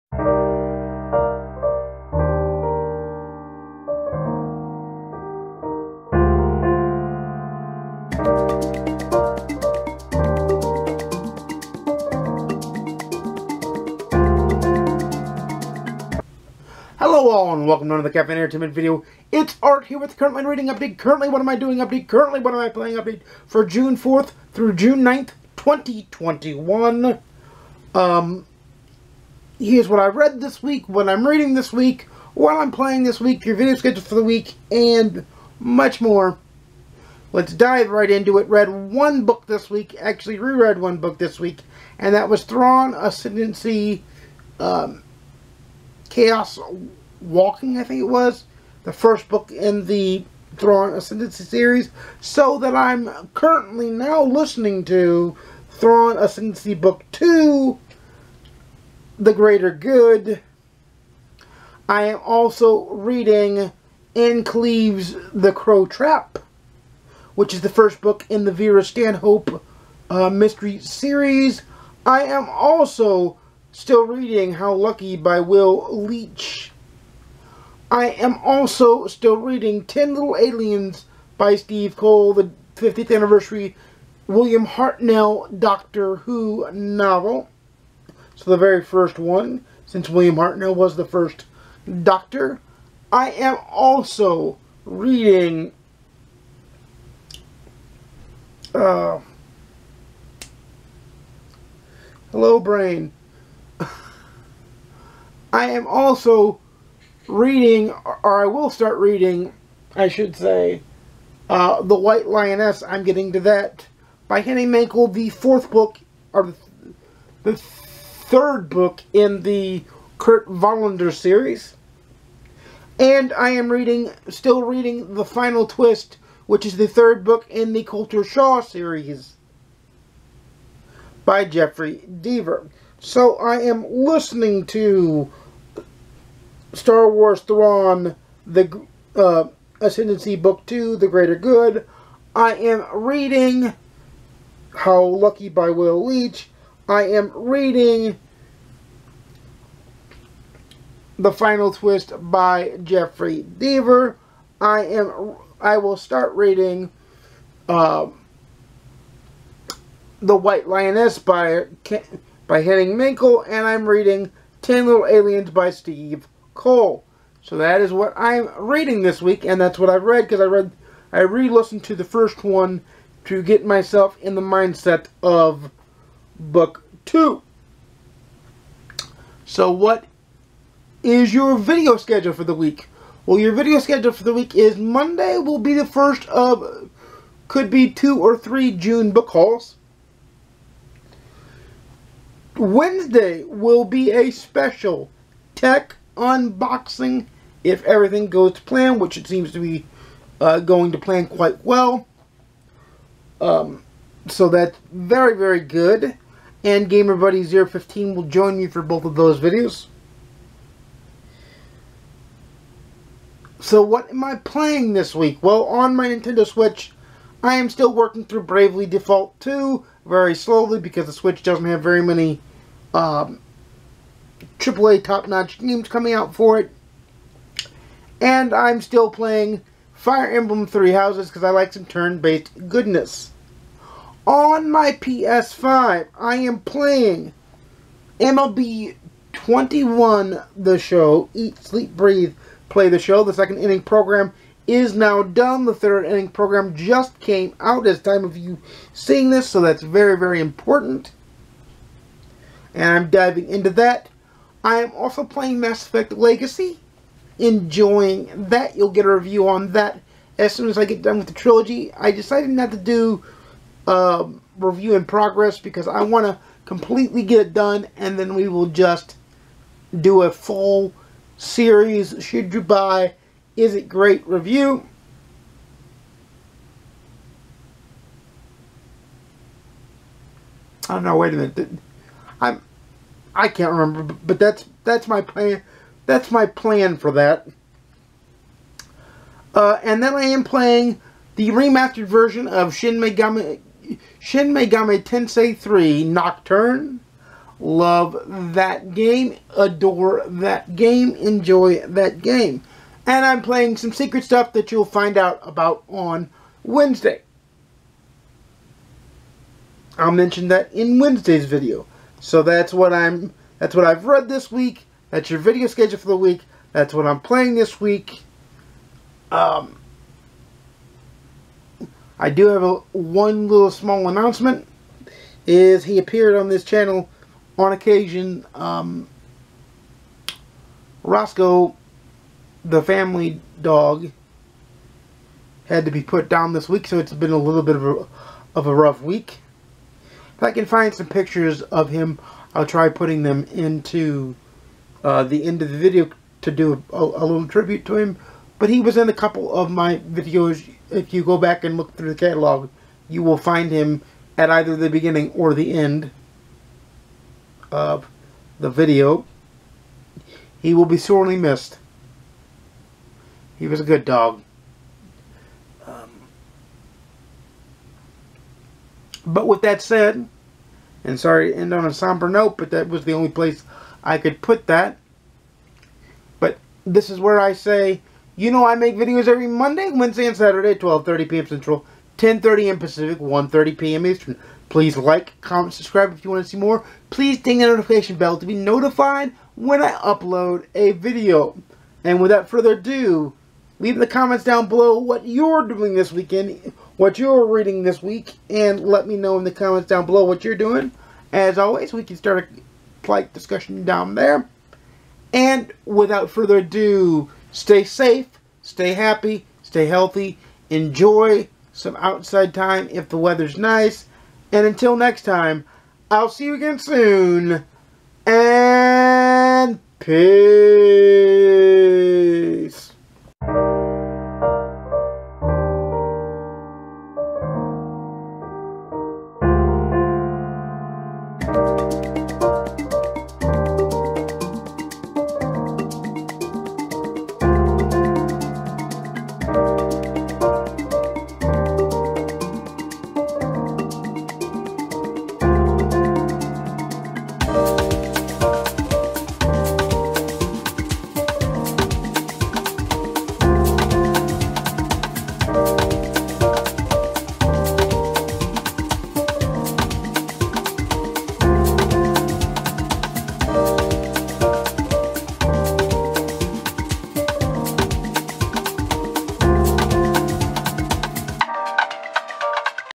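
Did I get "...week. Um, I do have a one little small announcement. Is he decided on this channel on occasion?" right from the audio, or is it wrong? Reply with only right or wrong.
wrong.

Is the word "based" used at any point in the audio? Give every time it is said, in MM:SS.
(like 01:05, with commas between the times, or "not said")
03:51.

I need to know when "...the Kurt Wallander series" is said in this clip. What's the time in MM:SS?
01:59.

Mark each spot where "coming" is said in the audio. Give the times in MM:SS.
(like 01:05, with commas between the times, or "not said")
03:45.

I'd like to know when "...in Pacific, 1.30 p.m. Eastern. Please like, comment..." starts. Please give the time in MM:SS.
06:22.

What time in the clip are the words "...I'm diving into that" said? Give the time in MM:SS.
04:12.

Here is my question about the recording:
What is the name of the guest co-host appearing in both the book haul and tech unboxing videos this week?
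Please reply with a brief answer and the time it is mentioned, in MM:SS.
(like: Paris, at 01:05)
Gamer Buddy 15, at 03:26.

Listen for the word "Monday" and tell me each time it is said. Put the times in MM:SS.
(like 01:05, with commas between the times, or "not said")
03:04, 06:19.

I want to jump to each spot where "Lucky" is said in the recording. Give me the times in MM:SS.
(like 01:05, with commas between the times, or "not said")
01:14, 02:25.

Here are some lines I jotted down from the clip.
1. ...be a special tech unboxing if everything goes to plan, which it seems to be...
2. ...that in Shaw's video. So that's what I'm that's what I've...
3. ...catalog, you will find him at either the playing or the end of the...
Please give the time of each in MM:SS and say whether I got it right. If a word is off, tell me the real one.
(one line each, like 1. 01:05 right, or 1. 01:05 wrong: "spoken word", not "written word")
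1. 03:13 right
2. 05:10 wrong: "Wednesday", not "Shaw"
3. 05:52 wrong: "beginning", not "playing".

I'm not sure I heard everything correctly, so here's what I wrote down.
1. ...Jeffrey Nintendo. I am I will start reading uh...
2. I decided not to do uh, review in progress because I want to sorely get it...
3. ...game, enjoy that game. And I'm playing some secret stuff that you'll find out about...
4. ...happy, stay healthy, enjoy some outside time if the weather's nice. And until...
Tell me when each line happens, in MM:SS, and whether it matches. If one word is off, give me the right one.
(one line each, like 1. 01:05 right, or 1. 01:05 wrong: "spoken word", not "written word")
1. 02:32 wrong: "Deaver", not "Nintendo"
2. 04:21 wrong: "completely", not "sorely"
3. 05:00 right
4. 06:48 right.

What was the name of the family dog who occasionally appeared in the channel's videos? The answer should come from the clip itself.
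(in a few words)
Roscoe.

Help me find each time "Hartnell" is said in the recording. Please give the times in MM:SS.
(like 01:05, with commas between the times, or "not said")
01:24, 01:30.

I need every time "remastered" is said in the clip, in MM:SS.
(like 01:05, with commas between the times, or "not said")
04:51.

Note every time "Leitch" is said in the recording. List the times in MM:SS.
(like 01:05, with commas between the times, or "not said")
01:15, 02:26.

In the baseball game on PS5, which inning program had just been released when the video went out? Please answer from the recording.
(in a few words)
third inning.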